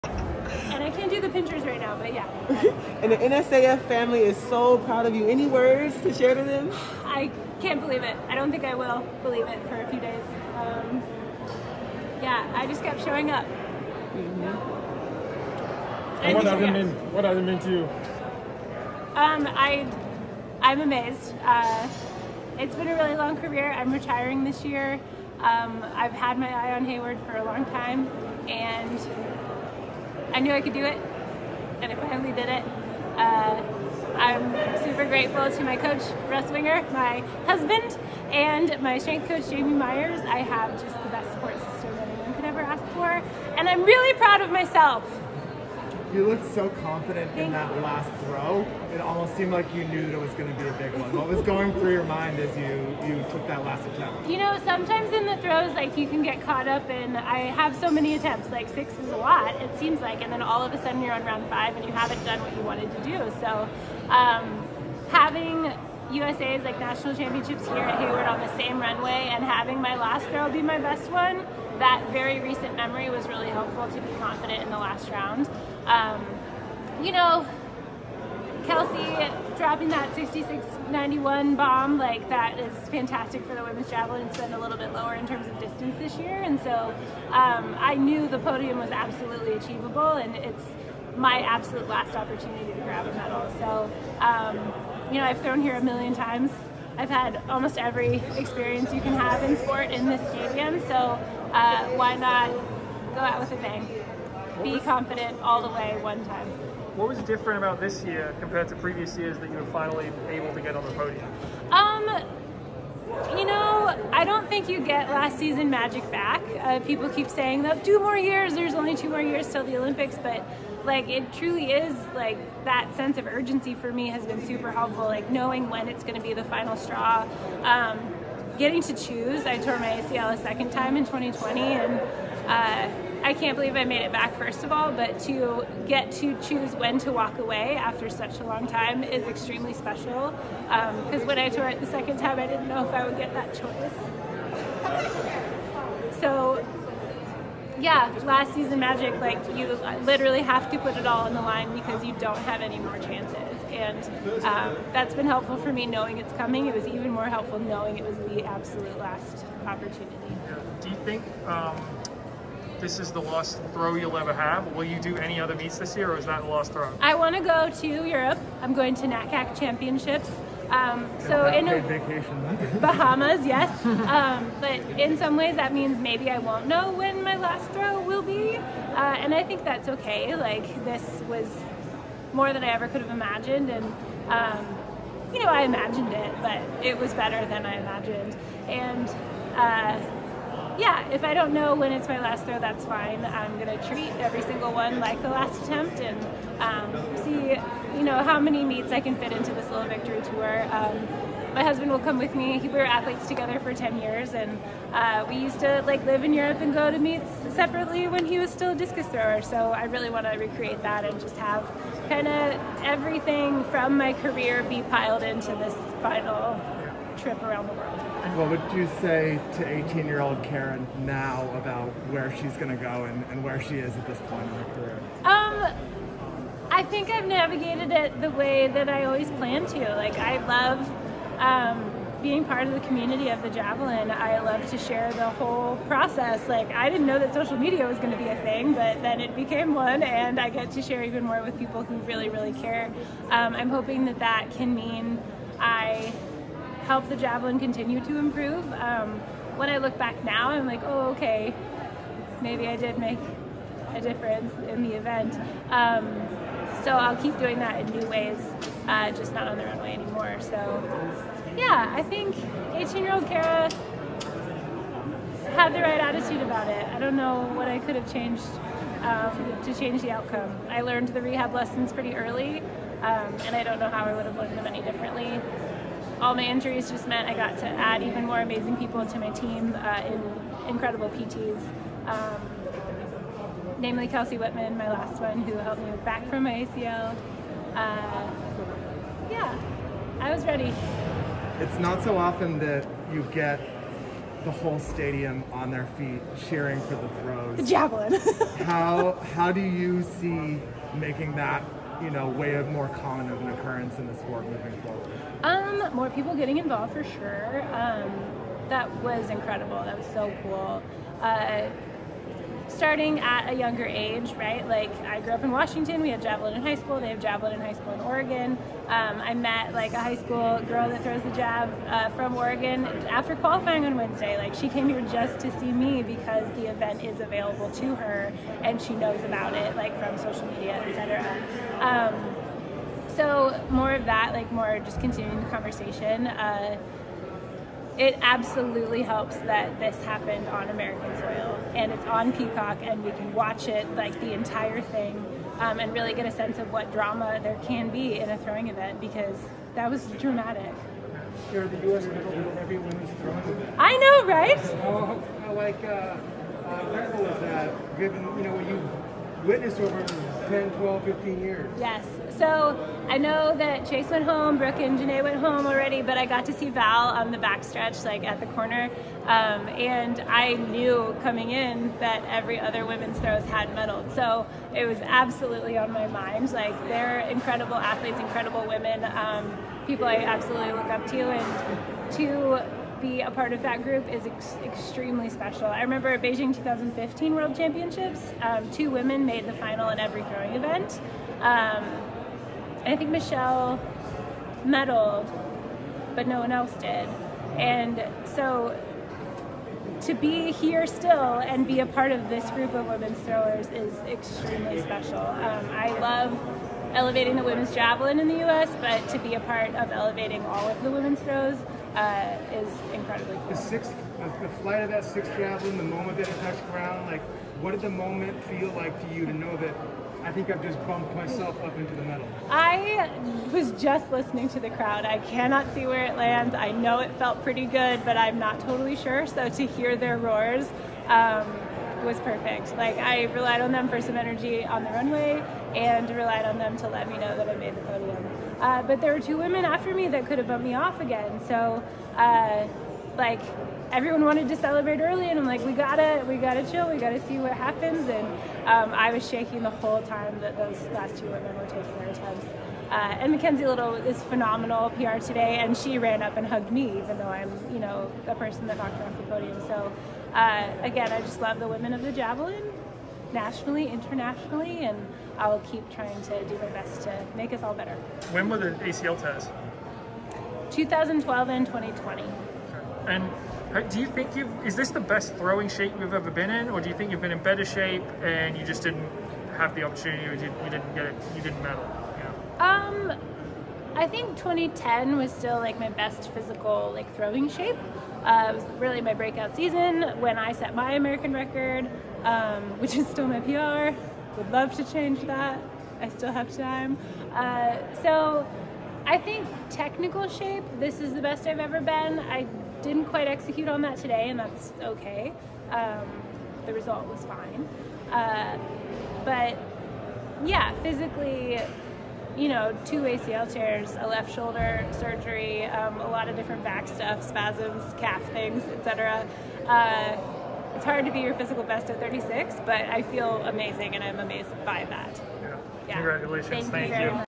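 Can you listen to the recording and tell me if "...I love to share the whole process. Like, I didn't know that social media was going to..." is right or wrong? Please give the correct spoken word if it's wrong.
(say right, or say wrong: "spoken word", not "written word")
right.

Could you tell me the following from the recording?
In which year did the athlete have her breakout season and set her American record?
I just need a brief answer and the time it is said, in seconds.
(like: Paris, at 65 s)
2010, at 484 s.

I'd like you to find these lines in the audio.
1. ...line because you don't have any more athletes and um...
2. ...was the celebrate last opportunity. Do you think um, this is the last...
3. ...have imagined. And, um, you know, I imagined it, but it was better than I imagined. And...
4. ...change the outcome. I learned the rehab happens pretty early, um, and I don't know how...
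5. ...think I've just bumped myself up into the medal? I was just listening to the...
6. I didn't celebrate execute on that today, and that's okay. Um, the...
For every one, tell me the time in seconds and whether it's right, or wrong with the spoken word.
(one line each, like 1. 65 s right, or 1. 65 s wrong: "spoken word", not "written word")
1. 151 s wrong: "chances", not "athletes"
2. 158 s wrong: "absolute", not "celebrate"
3. 183 s right
4. 269 s wrong: "lessons", not "happens"
5. 420 s right
6. 502 s wrong: "quite", not "celebrate".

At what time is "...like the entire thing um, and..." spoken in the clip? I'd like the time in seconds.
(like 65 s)
343 s.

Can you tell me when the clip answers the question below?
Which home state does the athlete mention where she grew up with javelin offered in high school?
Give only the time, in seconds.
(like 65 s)
315 s.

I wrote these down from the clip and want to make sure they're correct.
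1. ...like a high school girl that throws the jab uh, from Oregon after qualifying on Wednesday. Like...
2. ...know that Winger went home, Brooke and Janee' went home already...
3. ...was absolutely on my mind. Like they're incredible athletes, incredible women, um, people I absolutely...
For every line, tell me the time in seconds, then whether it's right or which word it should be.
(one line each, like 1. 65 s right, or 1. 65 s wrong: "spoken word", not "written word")
1. 319 s right
2. 363 s wrong: "Chase", not "Winger"
3. 374 s right.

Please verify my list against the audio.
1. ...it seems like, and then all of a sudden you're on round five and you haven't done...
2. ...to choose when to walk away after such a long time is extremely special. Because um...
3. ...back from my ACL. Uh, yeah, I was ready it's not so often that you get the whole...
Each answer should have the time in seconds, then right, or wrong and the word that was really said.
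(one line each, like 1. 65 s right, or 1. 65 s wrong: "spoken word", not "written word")
1. 59 s right
2. 136 s right
3. 286 s right.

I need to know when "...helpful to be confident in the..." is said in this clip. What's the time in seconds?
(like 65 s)
73 s.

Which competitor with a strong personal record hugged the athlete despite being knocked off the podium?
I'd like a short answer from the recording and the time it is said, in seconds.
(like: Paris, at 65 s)
Mackenzie Little, at 453 s.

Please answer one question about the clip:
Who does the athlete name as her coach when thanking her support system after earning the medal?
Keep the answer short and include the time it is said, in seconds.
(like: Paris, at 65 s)
Russ Winger, at 36 s.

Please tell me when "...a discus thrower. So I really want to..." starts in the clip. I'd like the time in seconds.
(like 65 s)
208 s.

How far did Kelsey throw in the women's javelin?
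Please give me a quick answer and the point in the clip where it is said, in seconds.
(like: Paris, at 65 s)
66.91, at 80 s.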